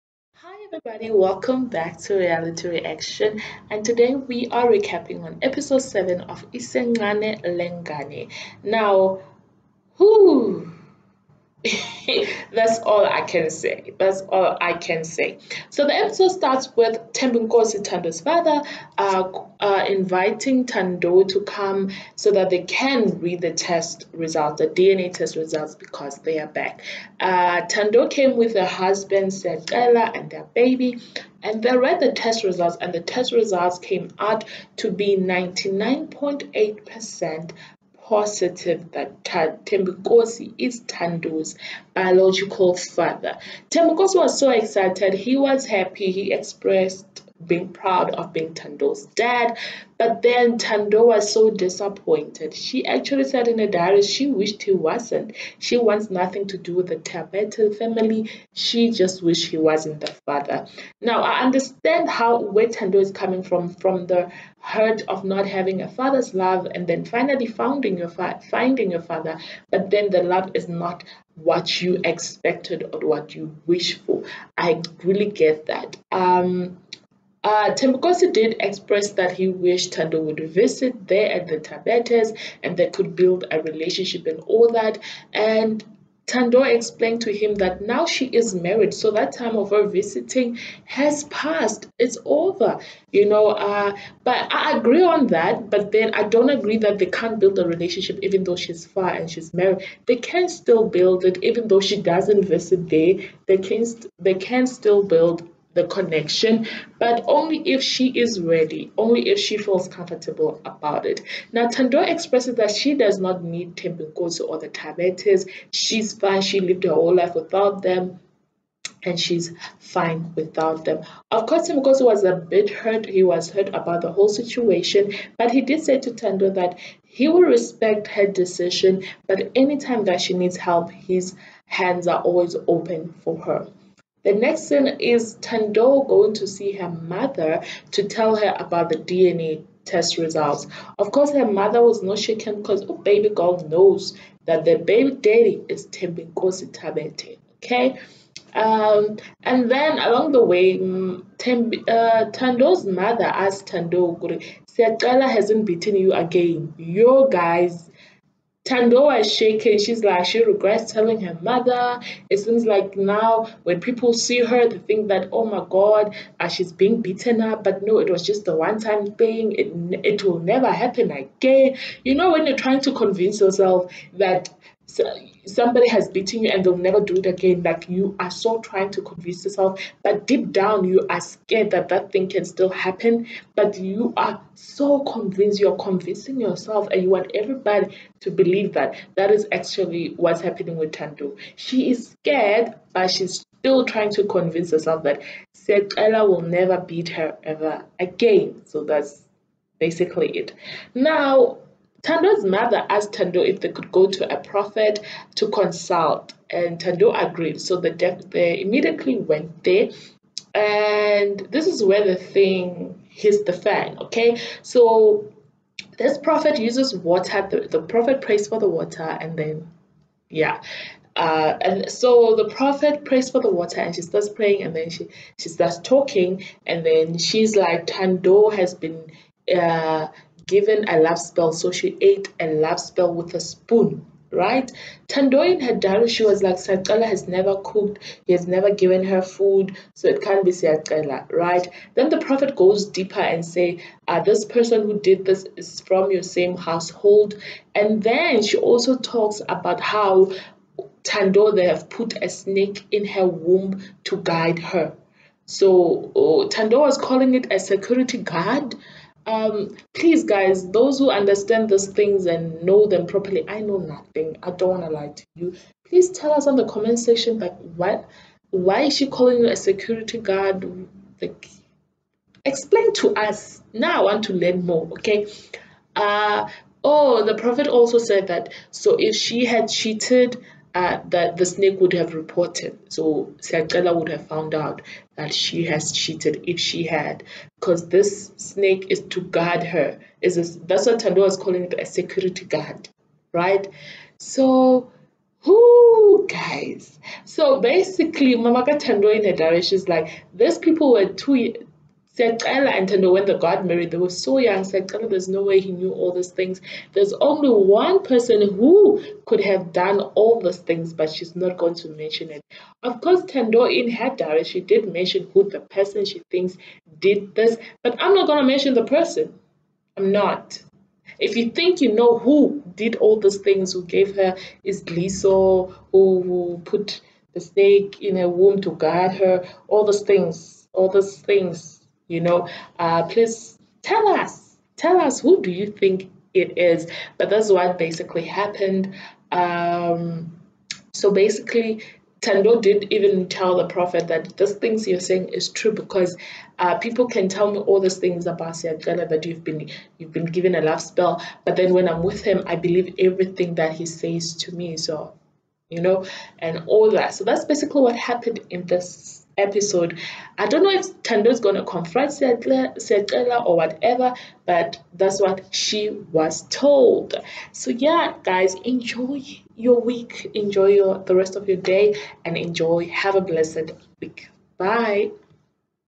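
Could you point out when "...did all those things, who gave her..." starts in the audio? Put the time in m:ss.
5:22.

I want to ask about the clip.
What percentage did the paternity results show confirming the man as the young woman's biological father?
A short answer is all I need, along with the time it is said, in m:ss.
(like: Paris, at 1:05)
99.8%, at 0:35.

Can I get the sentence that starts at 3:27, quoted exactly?
So the def- they immediately went there, and this is where the thing hits the fan.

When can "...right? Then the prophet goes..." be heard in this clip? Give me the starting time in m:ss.
4:01.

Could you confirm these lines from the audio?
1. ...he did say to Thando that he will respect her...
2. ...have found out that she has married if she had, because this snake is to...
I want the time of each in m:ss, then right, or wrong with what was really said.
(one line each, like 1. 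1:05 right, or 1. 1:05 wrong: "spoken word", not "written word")
1. 2:05 right
2. 4:44 wrong: "cheated", not "married".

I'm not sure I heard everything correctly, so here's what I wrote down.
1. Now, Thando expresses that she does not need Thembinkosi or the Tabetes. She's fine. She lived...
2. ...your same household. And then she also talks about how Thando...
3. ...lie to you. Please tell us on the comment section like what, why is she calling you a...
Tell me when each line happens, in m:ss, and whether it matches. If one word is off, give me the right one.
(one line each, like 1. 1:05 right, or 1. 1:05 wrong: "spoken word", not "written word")
1. 1:51 right
2. 4:06 right
3. 4:24 right.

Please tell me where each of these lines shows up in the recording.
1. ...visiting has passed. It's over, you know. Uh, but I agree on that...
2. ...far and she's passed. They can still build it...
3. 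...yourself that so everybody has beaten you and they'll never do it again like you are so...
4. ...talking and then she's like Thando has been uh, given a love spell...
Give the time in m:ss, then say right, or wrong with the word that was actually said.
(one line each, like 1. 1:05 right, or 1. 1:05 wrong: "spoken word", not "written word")
1. 1:29 right
2. 1:38 wrong: "married", not "passed"
3. 2:53 wrong: "somebody", not "everybody"
4. 3:45 right.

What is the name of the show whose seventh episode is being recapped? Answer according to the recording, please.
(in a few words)
Isencane Lengane.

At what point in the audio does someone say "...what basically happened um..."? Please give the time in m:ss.
5:37.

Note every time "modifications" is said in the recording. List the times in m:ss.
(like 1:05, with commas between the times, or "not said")
not said.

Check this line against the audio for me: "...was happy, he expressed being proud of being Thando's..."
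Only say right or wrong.
right.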